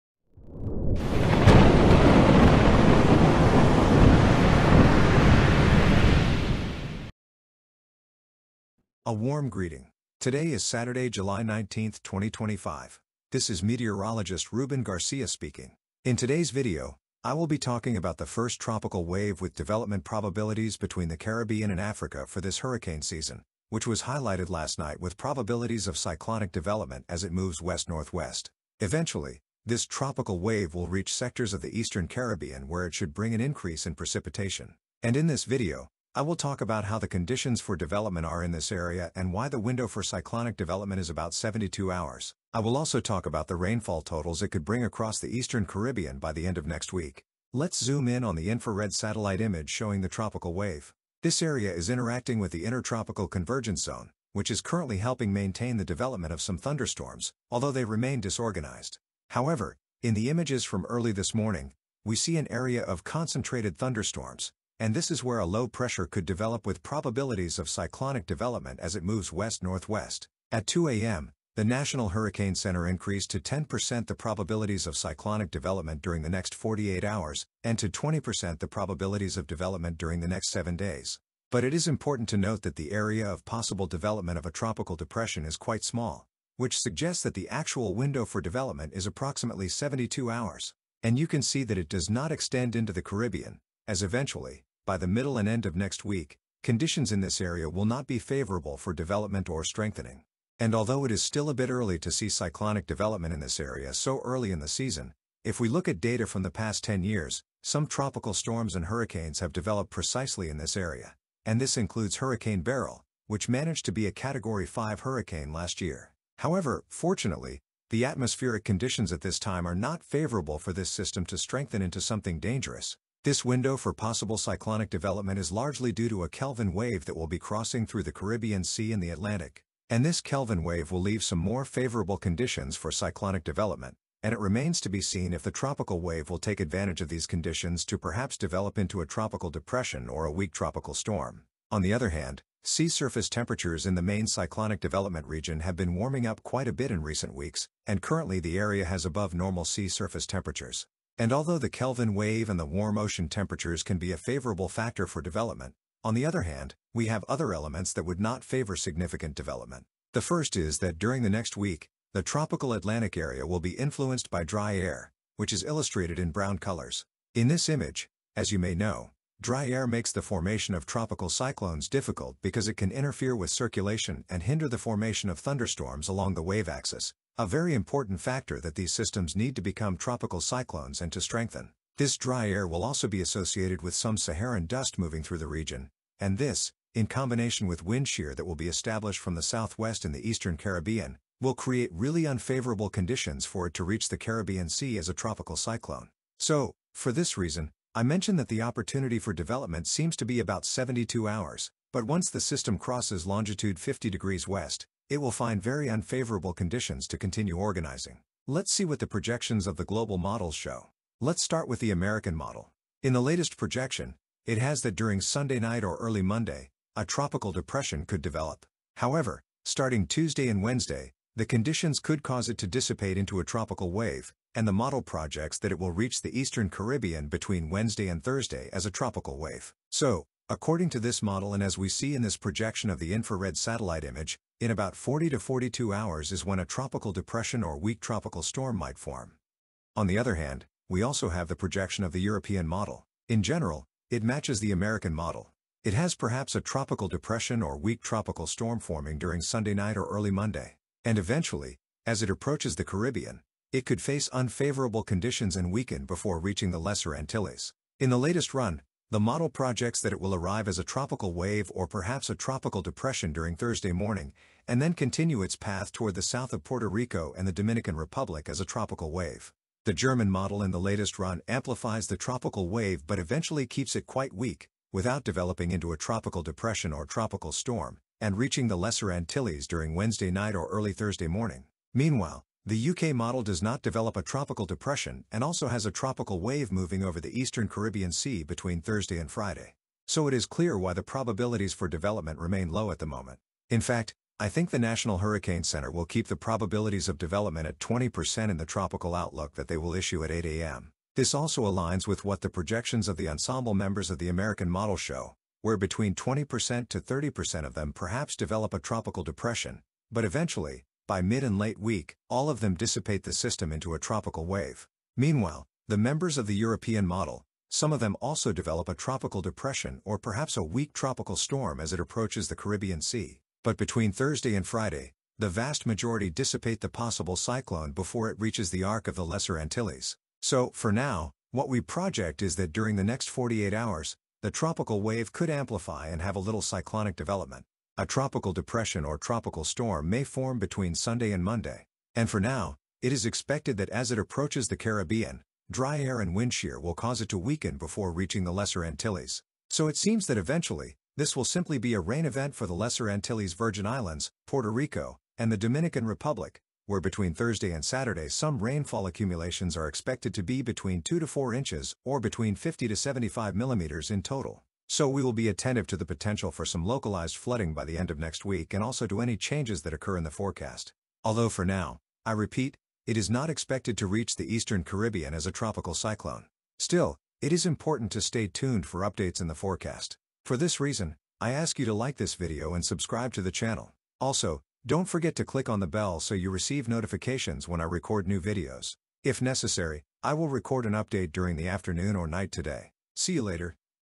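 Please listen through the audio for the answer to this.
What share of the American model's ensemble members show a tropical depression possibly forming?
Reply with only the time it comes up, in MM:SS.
05:05.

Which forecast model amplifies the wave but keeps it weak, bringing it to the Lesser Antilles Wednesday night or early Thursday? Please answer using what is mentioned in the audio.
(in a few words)
German model.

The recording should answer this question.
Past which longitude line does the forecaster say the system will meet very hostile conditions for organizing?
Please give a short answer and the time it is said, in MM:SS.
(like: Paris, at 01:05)
50 degrees west, at 03:23.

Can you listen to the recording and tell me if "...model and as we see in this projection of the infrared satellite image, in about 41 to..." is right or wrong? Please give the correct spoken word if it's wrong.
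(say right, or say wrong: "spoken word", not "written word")
wrong: "40", not "41".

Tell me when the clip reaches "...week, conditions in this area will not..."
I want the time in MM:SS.
01:36.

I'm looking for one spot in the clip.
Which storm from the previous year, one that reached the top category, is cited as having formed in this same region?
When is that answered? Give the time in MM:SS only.
01:52.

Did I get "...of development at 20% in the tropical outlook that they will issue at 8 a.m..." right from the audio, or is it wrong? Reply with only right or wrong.
right.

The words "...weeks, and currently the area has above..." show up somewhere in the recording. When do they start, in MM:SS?
02:27.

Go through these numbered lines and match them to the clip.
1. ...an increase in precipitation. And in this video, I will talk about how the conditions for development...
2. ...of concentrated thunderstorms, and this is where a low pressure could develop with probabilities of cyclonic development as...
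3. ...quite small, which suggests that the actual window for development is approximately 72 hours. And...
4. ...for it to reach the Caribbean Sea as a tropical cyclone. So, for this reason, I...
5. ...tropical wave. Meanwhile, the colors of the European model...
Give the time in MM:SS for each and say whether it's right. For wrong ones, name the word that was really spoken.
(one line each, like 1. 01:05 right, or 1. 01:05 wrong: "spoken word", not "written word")
1. 00:33 right
2. 01:02 right
3. 01:25 right
4. 03:13 right
5. 05:13 wrong: "members", not "colors".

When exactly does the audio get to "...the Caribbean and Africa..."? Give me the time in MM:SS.
00:21.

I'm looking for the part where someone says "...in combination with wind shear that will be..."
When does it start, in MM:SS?
03:06.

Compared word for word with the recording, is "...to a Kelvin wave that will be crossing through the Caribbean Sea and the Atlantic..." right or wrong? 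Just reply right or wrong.
right.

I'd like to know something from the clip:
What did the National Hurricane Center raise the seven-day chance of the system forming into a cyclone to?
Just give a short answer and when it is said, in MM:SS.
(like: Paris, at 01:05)
20%, at 01:17.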